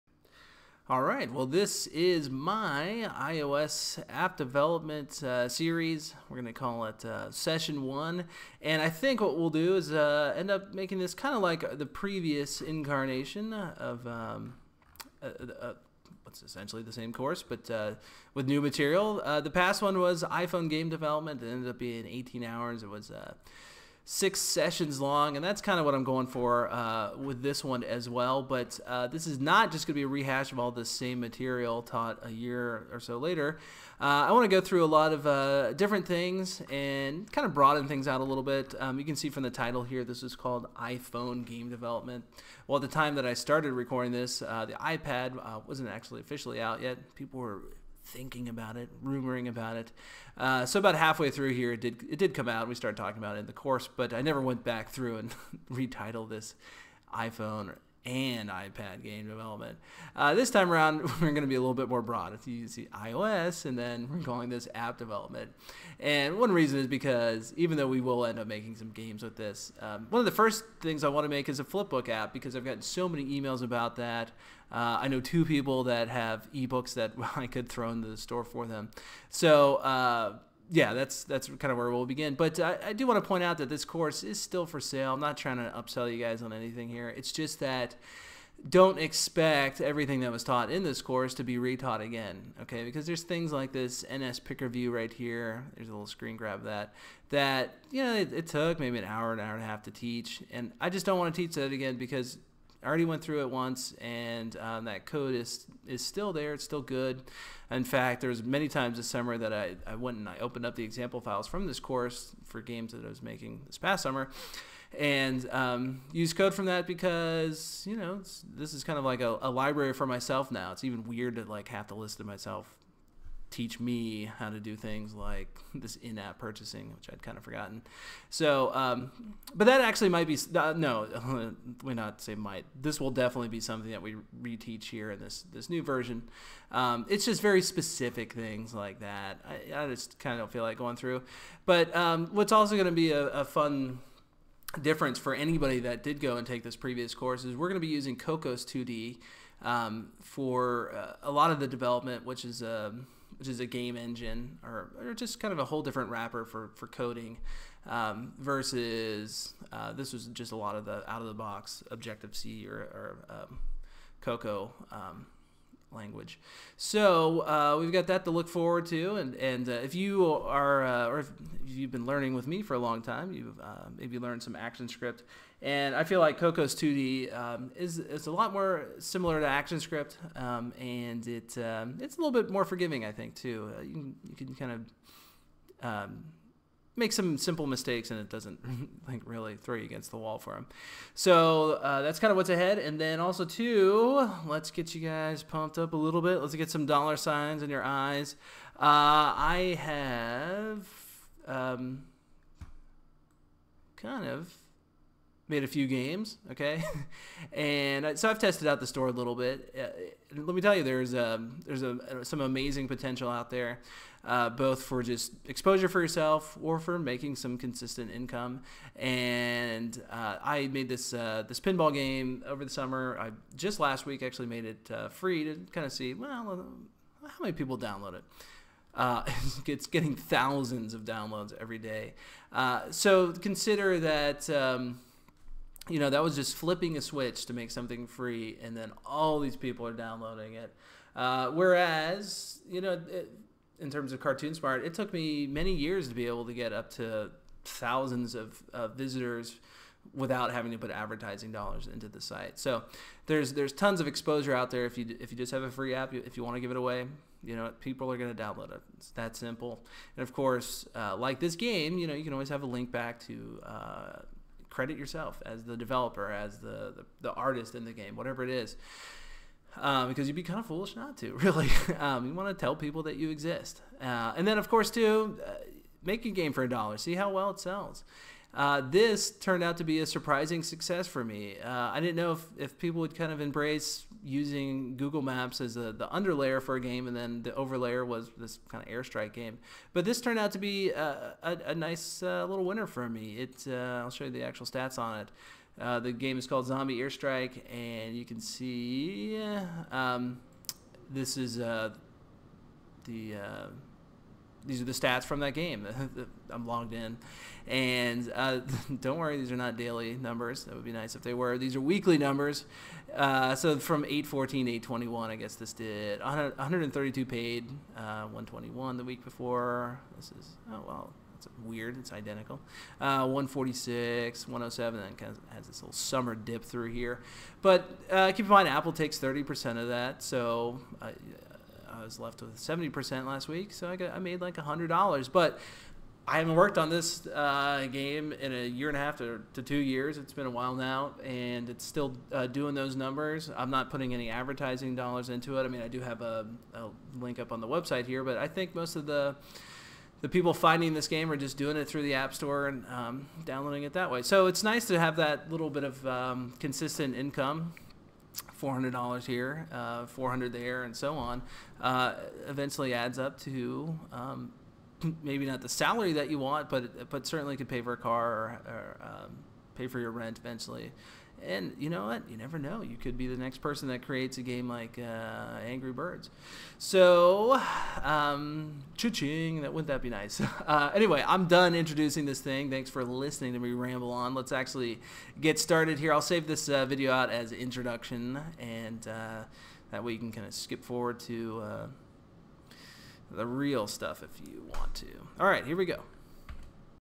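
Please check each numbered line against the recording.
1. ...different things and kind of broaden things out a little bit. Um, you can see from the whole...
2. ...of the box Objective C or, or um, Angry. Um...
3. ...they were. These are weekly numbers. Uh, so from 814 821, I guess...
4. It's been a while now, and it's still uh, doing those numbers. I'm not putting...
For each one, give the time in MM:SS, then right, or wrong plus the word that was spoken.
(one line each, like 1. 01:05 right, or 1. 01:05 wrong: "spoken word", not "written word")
1. 00:35 wrong: "title", not "whole"
2. 02:41 wrong: "Cocoa", not "Angry"
3. 05:11 right
4. 05:40 right.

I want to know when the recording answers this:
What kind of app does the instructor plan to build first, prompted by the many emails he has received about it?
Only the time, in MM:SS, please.
01:11.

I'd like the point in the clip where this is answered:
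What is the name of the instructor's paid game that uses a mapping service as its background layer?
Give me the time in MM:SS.
04:56.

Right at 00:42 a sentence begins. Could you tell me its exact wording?
Well, at the time that I started recording this, uh, the iPad uh, wasn't actually officially out yet.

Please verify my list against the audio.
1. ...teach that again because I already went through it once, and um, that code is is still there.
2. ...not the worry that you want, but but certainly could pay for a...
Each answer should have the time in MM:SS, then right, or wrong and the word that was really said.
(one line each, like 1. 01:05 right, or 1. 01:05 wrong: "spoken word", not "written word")
1. 01:41 right
2. 06:05 wrong: "salary", not "worry".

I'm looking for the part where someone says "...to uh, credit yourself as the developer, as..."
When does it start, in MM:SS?
04:23.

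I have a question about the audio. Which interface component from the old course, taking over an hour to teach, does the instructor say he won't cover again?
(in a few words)
NS Picker View.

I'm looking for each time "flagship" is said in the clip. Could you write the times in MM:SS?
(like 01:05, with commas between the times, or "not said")
not said.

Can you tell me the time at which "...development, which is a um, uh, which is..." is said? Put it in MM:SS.
02:31.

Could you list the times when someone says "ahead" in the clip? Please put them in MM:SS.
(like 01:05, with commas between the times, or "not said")
03:12.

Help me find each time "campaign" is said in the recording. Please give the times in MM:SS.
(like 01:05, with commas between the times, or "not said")
not said.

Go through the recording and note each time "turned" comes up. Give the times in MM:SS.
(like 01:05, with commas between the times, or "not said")
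04:39, 04:50.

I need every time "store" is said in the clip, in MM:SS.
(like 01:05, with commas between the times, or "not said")
01:18, 03:28, 05:52.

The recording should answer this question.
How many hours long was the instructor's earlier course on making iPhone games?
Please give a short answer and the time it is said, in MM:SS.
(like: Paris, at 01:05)
18 hours, at 00:22.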